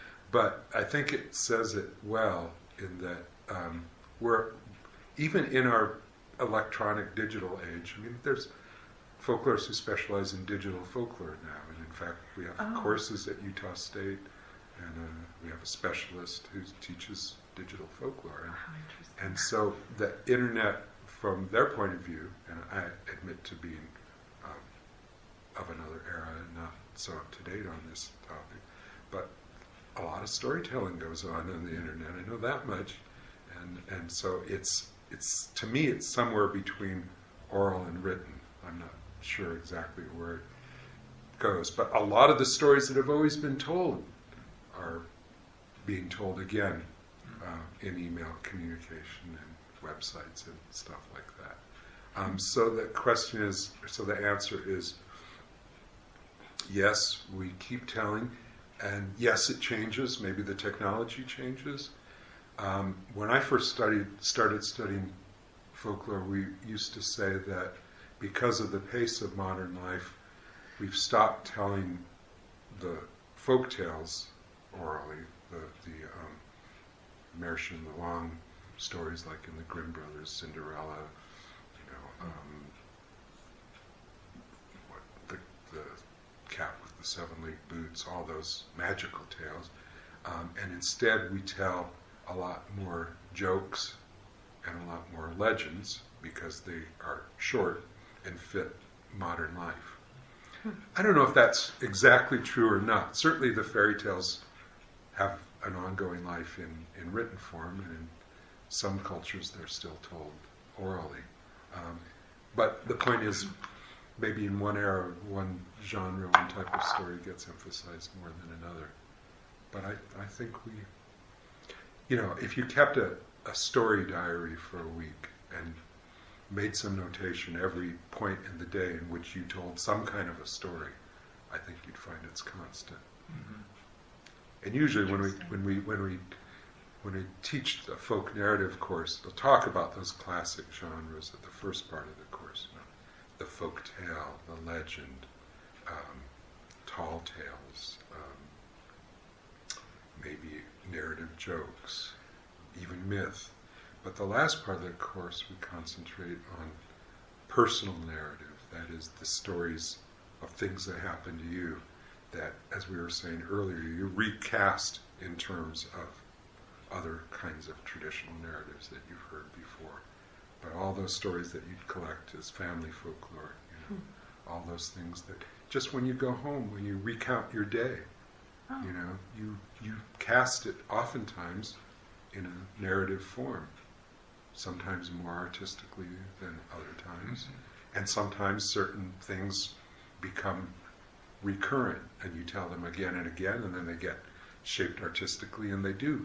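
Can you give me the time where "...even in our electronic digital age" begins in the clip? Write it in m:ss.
0:05.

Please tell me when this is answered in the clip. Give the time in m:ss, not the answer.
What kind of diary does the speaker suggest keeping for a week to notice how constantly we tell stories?
2:03.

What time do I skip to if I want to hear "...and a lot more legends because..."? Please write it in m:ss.
1:34.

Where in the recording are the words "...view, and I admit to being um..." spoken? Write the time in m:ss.
0:22.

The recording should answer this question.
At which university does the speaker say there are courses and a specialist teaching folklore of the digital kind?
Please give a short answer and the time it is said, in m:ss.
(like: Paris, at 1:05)
Utah State, at 0:13.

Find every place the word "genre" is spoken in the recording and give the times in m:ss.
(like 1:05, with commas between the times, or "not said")
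1:55, 2:20.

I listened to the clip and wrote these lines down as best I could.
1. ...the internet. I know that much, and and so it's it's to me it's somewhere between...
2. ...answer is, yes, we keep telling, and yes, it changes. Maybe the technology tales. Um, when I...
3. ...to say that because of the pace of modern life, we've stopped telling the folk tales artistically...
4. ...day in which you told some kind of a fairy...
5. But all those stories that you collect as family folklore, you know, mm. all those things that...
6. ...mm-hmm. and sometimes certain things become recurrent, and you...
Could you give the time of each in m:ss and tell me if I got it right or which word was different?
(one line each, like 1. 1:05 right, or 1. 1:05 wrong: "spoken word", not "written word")
1. 0:31 right
2. 0:54 wrong: "changes", not "tales"
3. 1:06 wrong: "orally", not "artistically"
4. 2:08 wrong: "story", not "fairy"
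5. 2:50 right
6. 3:07 right.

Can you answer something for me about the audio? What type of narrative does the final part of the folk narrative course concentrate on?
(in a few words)
personal narrative.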